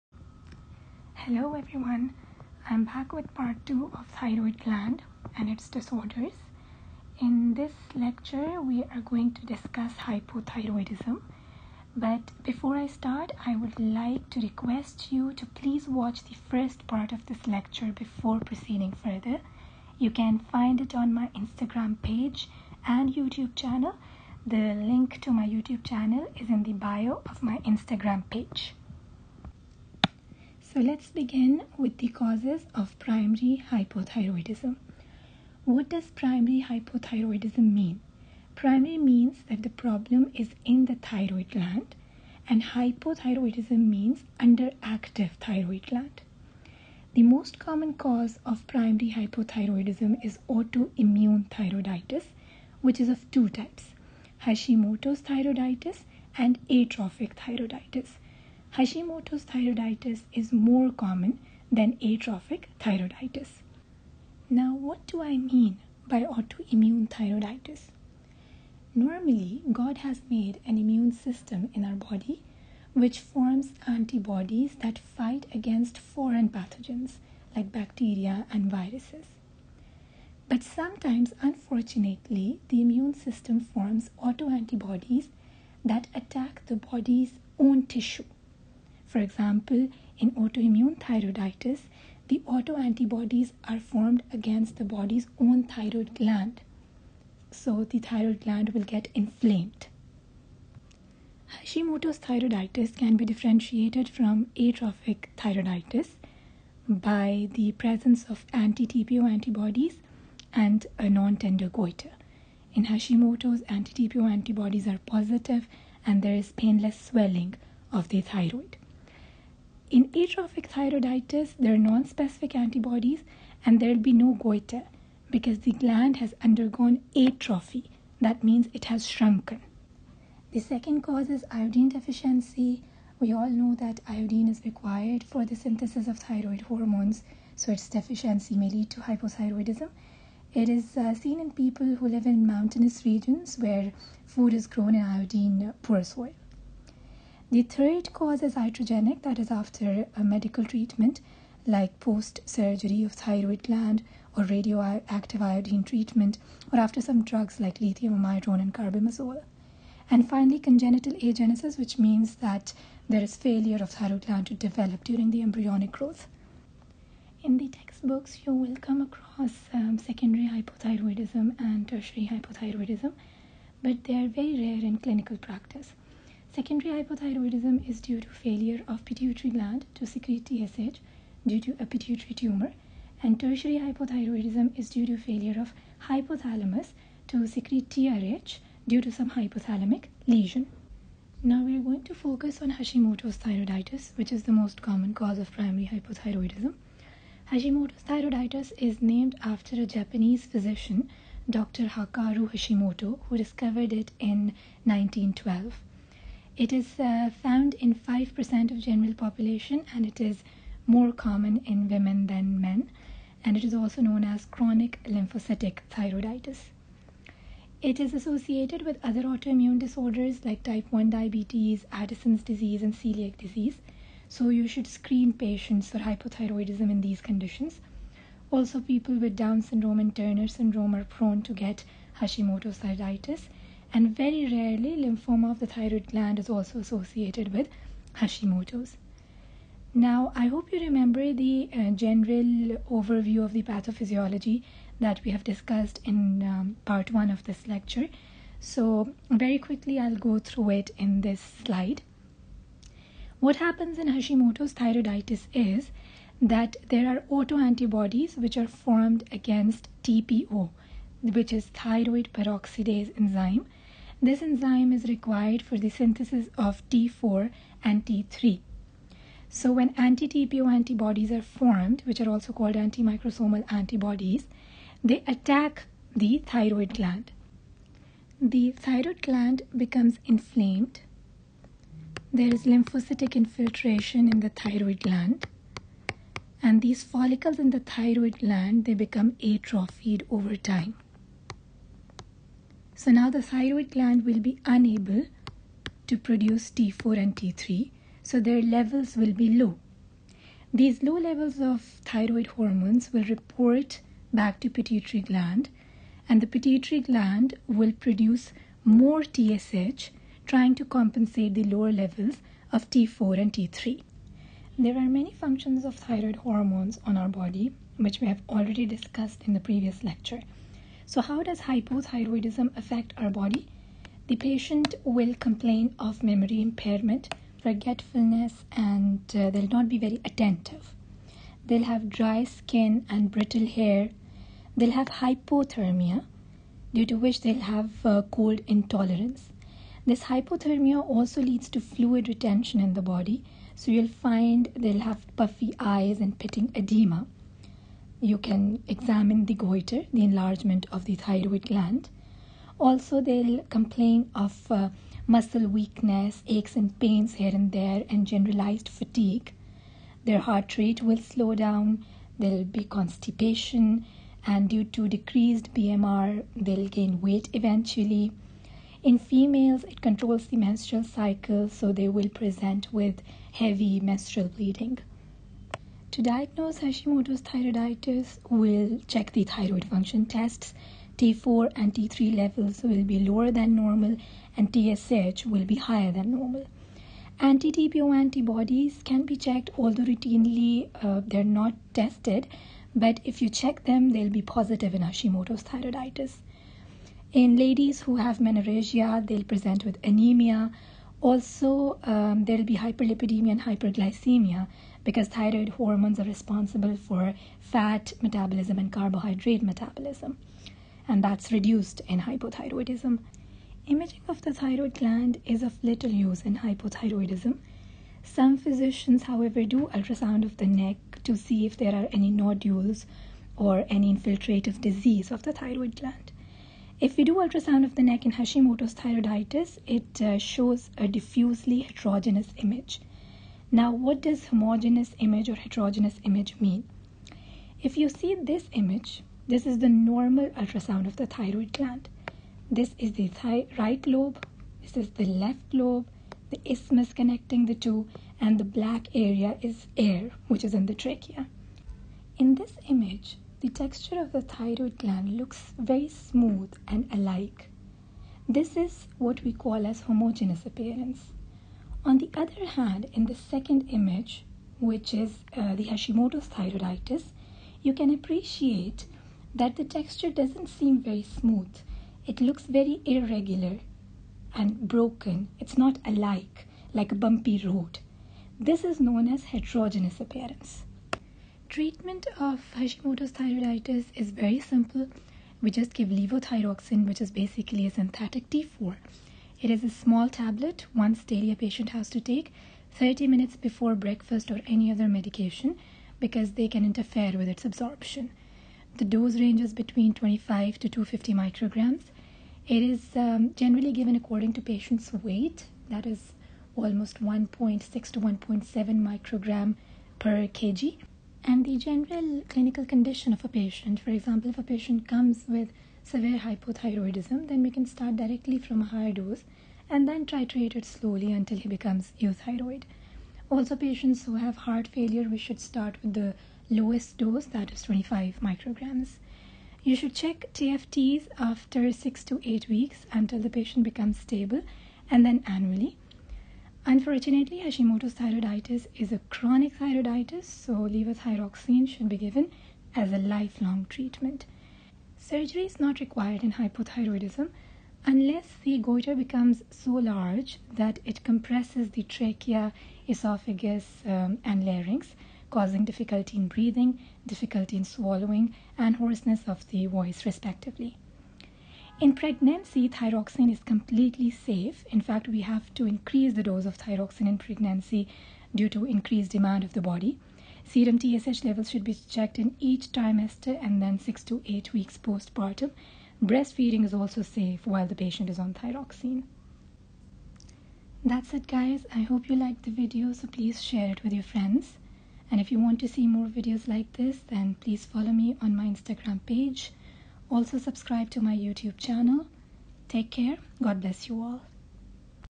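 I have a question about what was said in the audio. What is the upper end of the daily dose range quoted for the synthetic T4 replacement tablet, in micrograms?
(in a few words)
250 micrograms.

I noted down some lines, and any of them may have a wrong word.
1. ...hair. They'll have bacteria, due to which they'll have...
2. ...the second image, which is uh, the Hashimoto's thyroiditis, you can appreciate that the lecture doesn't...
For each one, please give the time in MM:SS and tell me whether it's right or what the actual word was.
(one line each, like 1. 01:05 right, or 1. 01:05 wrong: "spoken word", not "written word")
1. 05:33 wrong: "hypothermia", not "bacteria"
2. 07:43 wrong: "texture", not "lecture".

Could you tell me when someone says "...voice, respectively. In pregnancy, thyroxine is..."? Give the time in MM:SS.
09:19.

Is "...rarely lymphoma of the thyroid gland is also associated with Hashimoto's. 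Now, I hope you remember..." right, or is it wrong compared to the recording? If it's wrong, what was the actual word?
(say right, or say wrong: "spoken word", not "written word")
right.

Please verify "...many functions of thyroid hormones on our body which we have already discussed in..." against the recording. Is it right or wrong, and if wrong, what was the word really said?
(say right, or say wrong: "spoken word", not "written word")
right.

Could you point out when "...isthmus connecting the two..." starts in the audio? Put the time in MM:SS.
07:26.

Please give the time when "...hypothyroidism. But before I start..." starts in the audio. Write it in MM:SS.
00:09.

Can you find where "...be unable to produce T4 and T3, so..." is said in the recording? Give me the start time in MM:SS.
04:54.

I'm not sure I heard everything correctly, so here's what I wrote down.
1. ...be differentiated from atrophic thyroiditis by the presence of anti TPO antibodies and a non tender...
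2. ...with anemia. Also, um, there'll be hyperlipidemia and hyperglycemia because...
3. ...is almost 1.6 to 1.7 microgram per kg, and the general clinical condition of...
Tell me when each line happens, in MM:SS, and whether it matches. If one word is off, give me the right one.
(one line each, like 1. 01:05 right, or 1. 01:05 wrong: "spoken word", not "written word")
1. 01:43 right
2. 06:39 right
3. 08:26 right.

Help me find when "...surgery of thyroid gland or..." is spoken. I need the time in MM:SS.
02:32.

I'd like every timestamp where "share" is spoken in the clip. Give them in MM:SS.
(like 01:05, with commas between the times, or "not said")
09:43.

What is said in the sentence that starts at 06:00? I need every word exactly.
Their heart rate will slow down, there'll be constipation, and due to decreased BMR, they'll gain weight eventually.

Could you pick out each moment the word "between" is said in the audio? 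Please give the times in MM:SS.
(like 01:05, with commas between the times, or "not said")
08:19.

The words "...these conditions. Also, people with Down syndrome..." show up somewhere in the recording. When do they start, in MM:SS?
03:46.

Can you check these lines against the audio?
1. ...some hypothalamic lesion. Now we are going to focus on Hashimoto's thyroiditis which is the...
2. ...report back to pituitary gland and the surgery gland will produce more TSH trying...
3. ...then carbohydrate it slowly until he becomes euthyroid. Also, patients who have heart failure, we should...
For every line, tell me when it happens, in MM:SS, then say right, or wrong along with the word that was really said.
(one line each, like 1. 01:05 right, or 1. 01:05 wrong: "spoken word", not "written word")
1. 03:09 right
2. 05:03 wrong: "pituitary", not "surgery"
3. 08:40 wrong: "titrate", not "carbohydrate".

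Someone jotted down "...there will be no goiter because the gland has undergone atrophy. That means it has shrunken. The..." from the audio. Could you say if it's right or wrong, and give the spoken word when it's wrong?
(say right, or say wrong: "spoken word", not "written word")
right.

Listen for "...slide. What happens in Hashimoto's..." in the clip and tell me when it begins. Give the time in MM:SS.
04:11.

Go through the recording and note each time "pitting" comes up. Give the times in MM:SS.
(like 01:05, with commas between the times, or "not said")
05:46.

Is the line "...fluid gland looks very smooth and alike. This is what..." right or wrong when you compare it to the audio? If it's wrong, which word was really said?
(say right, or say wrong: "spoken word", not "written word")
wrong: "thyroid", not "fluid".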